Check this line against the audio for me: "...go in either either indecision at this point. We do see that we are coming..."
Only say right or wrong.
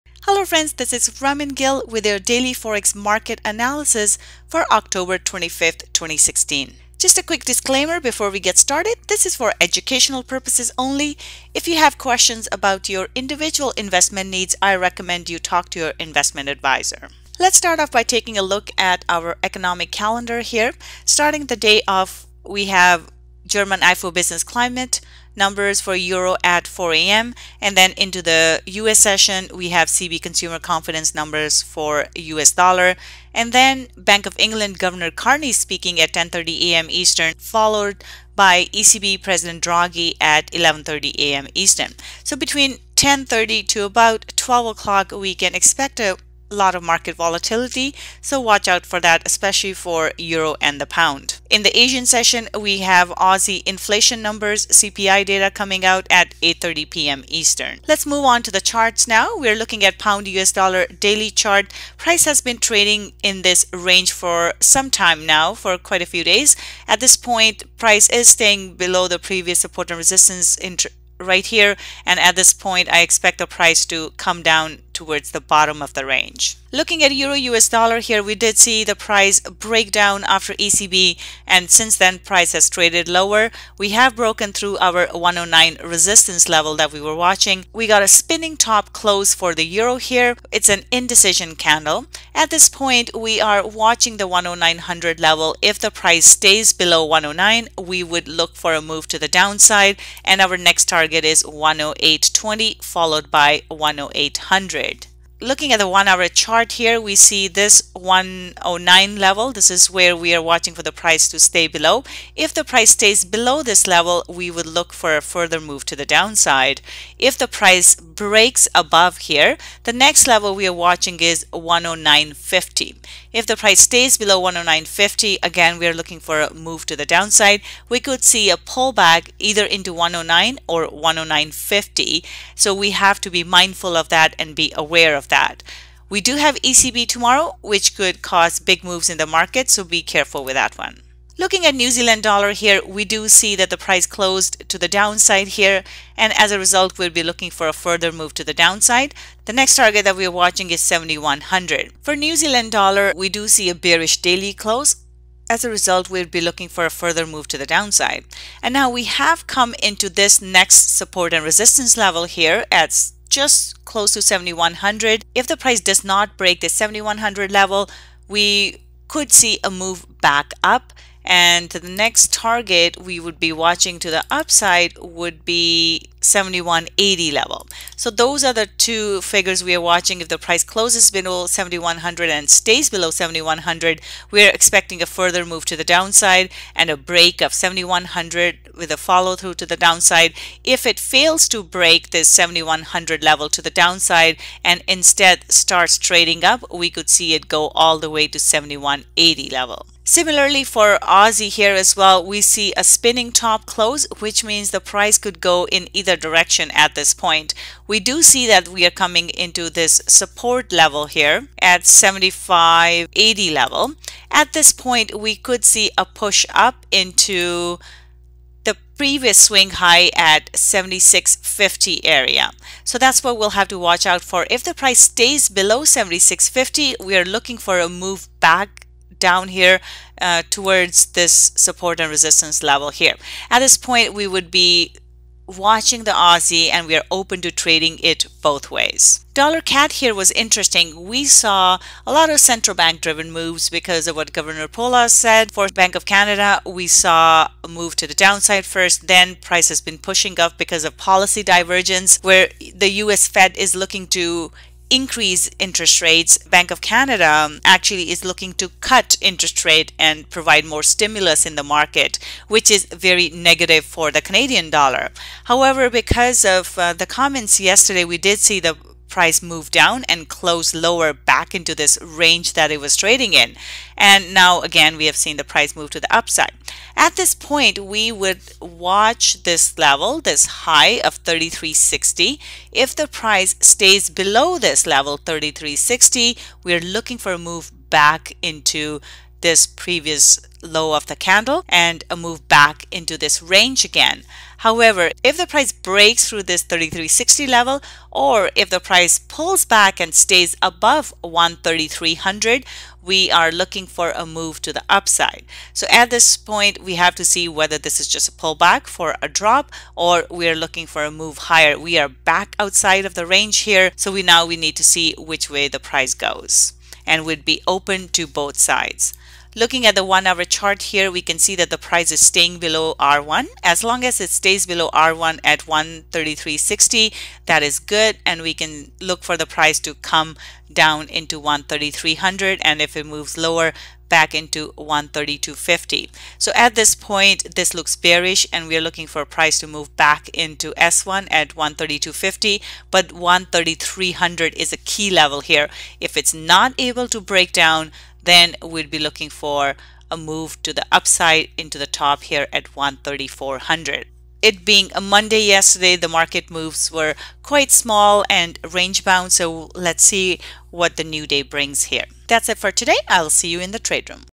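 wrong.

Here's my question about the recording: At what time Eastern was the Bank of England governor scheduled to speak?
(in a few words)
10:30 a.m.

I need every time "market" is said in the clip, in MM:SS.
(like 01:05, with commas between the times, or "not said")
00:02, 00:46, 02:19, 04:21, 05:56.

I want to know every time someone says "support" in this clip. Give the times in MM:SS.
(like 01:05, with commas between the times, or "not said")
01:09, 02:40, 03:30, 03:51.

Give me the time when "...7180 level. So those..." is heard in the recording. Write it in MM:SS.
02:56.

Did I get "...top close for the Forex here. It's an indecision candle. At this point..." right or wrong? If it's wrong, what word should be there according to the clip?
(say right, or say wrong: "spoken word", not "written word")
wrong: "Euro", not "Forex".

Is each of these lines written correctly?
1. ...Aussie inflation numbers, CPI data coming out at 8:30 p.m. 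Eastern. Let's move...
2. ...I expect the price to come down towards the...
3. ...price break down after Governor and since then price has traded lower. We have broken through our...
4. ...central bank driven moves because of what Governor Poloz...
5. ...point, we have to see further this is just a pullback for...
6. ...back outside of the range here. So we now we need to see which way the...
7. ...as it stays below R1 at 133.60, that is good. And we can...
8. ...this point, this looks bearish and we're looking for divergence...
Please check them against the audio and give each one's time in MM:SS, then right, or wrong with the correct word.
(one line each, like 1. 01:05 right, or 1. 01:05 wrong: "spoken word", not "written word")
1. 00:53 right
2. 01:12 right
3. 01:18 wrong: "ECB", not "Governor"
4. 04:02 right
5. 05:06 wrong: "whether", not "further"
6. 05:12 right
7. 05:24 right
8. 05:36 wrong: "price", not "divergence".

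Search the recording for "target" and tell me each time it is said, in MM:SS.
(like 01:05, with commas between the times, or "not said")
01:40, 02:29, 02:52.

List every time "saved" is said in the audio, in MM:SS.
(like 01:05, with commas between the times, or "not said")
not said.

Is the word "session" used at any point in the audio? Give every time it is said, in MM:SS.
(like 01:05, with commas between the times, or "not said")
00:28, 00:52.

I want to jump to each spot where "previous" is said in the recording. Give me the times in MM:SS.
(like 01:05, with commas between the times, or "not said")
01:09, 03:38, 04:49.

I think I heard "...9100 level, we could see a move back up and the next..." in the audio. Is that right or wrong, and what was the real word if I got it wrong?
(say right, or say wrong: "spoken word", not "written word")
wrong: "7100", not "9100".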